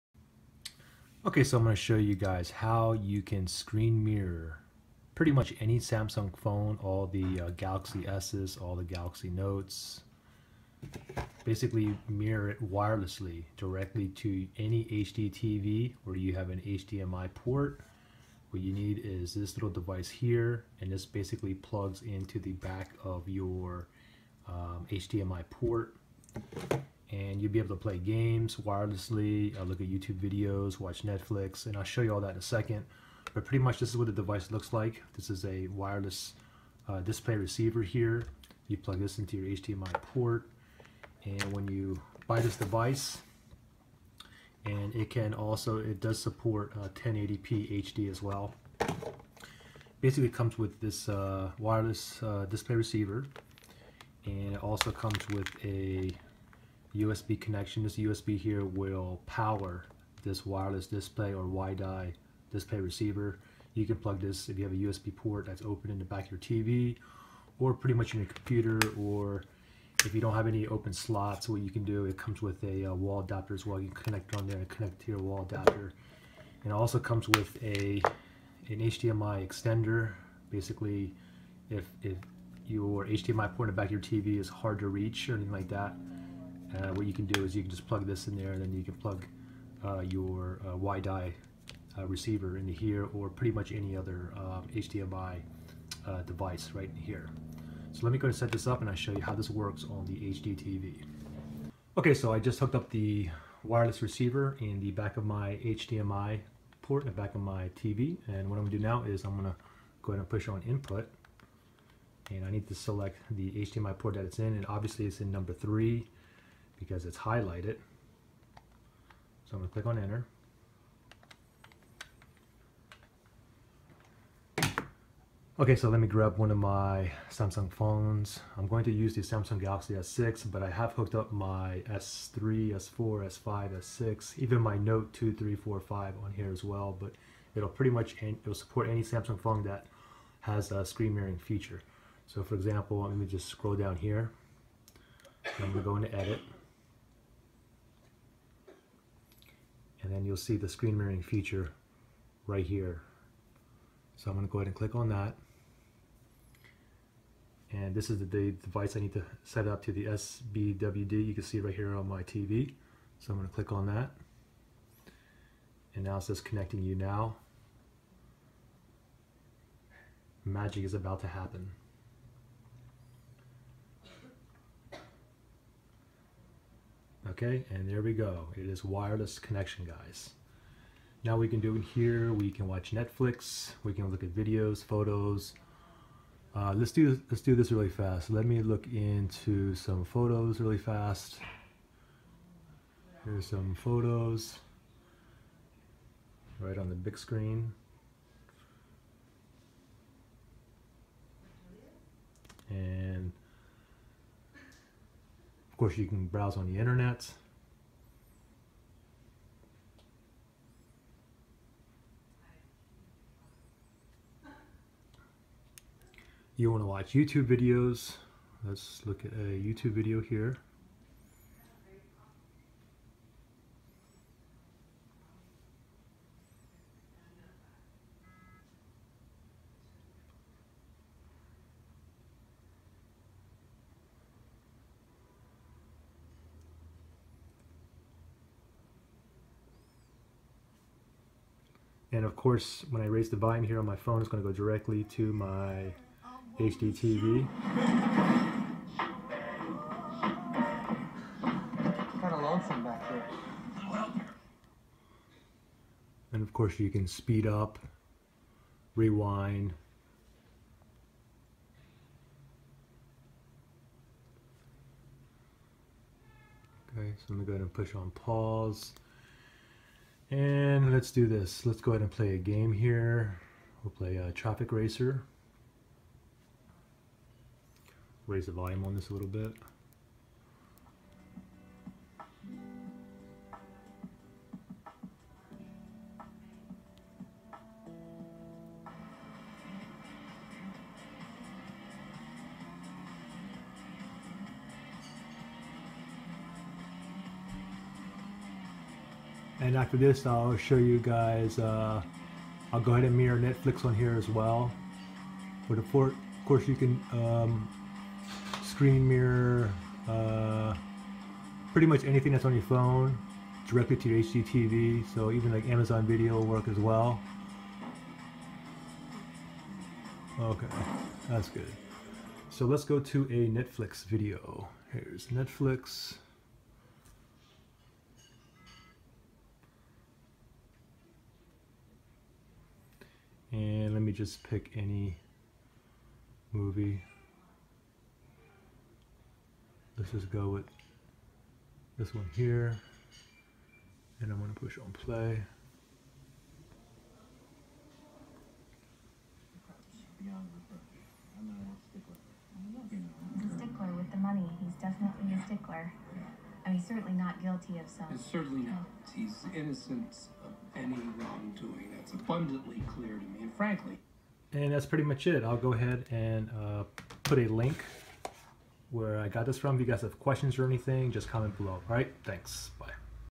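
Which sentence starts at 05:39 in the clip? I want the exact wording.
Let's just go with this one here.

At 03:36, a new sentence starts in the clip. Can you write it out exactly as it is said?
You want to watch YouTube videos.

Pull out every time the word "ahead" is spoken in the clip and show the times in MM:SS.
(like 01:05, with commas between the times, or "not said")
01:50, 02:34, 04:27, 04:31, 05:02, 06:05.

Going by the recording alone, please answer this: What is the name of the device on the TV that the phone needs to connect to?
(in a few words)
SBWD.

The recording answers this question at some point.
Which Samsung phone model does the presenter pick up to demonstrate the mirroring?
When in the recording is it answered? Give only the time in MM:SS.
02:09.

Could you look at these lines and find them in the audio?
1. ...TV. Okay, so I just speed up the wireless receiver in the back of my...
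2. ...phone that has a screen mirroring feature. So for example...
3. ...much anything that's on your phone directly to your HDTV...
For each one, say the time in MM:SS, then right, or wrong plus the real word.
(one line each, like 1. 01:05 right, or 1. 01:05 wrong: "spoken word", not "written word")
1. 01:40 wrong: "hooked", not "speed"
2. 02:19 right
3. 05:11 right.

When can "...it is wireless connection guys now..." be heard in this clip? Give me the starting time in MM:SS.
02:58.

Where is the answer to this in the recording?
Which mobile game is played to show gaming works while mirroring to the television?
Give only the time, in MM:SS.
04:34.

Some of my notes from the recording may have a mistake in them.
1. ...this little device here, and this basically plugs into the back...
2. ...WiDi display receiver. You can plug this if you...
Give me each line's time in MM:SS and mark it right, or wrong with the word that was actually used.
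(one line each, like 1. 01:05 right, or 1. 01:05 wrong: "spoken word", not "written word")
1. 00:19 right
2. 01:01 right.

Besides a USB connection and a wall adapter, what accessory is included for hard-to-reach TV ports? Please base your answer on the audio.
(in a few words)
HDMI extender.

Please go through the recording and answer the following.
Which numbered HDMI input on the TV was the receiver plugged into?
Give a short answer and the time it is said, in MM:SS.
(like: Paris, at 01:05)
3, at 01:55.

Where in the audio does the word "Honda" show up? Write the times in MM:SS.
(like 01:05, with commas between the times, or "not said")
not said.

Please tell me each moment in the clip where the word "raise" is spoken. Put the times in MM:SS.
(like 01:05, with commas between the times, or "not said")
04:03, 04:38.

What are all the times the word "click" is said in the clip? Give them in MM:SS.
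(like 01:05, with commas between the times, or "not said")
01:59, 02:34, 02:43.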